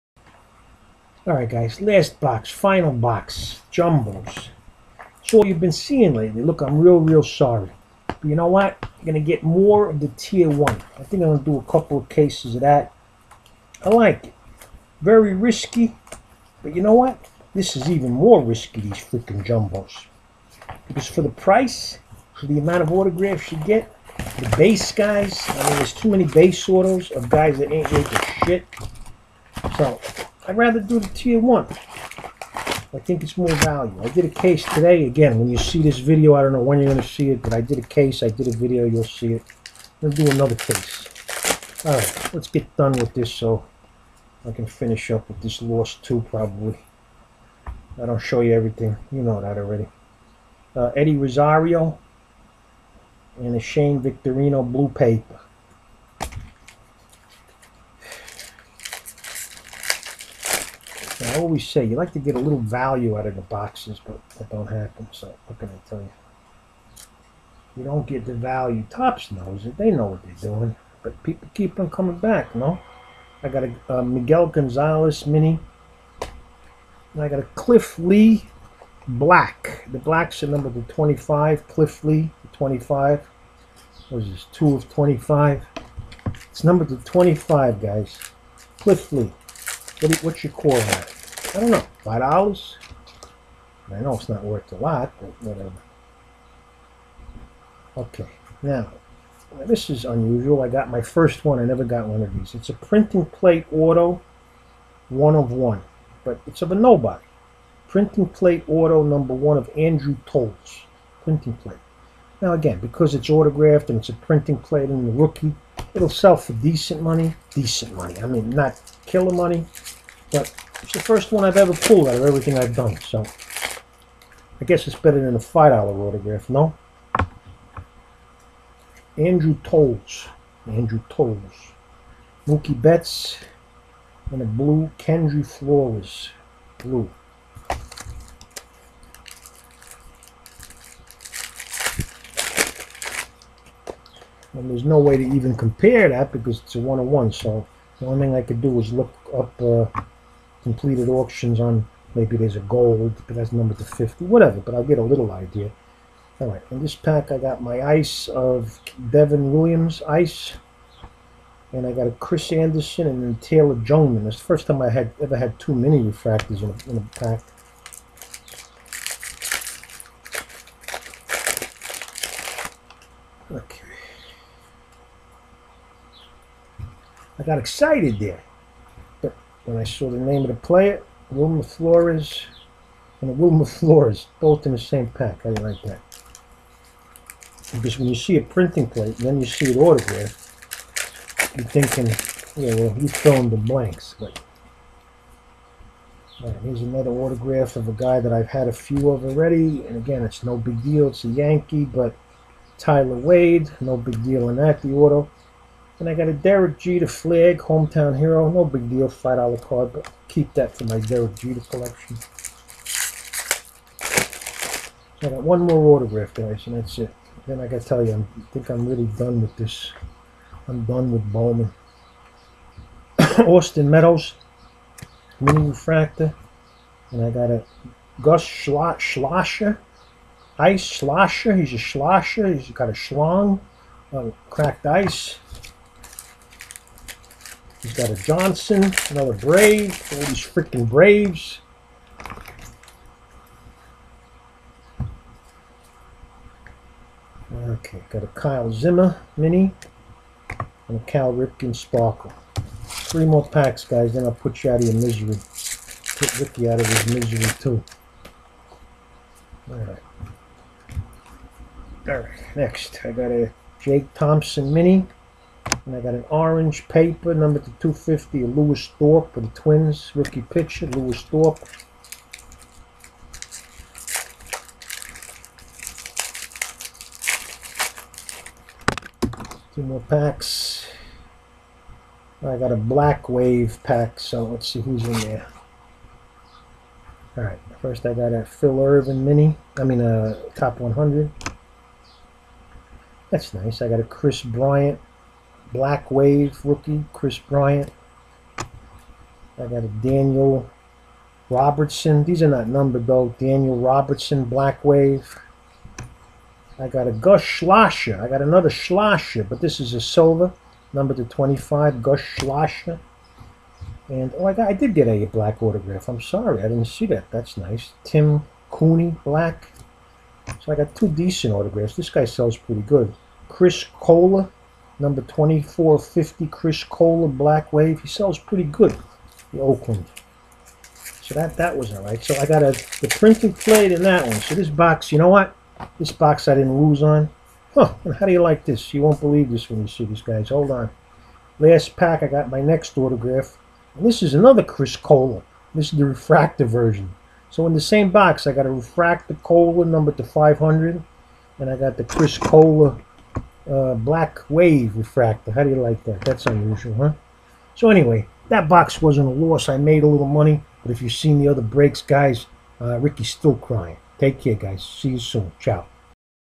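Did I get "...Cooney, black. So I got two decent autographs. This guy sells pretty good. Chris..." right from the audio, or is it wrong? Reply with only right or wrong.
right.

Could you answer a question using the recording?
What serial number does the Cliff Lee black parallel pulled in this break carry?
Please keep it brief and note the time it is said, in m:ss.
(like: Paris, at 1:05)
2 of 25, at 1:24.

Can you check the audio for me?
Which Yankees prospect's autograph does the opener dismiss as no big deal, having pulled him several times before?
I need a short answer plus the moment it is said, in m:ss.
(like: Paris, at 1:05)
Tyler Wade, at 3:22.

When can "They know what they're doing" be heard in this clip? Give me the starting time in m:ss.
1:09.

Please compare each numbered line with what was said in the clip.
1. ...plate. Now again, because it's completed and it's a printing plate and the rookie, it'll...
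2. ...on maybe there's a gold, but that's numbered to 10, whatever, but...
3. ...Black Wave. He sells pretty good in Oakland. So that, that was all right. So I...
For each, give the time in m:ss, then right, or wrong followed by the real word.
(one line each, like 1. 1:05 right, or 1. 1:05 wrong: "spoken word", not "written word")
1. 1:51 wrong: "autographed", not "completed"
2. 2:31 wrong: "50", not "10"
3. 5:27 right.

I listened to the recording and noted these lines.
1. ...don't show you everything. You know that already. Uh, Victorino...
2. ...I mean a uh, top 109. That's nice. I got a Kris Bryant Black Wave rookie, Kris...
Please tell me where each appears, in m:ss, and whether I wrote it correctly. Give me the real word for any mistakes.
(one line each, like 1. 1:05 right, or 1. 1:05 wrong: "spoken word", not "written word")
1. 0:48 wrong: "Eddie", not "Victorino"
2. 4:49 wrong: "100", not "109".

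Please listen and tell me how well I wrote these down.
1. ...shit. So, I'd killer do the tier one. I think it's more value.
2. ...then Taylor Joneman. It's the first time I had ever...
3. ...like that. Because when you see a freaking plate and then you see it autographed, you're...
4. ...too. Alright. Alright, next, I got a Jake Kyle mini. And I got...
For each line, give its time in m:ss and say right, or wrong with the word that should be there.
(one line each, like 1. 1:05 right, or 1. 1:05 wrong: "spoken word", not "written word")
1. 0:28 wrong: "rather", not "killer"
2. 2:43 right
3. 3:05 wrong: "printing", not "freaking"
4. 4:17 wrong: "Thompson", not "Kyle".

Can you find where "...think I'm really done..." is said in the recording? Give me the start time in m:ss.
3:38.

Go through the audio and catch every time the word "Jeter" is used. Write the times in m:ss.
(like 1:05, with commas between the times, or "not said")
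3:26, 3:31.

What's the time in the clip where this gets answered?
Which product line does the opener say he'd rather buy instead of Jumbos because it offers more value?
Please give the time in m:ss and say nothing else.
0:10.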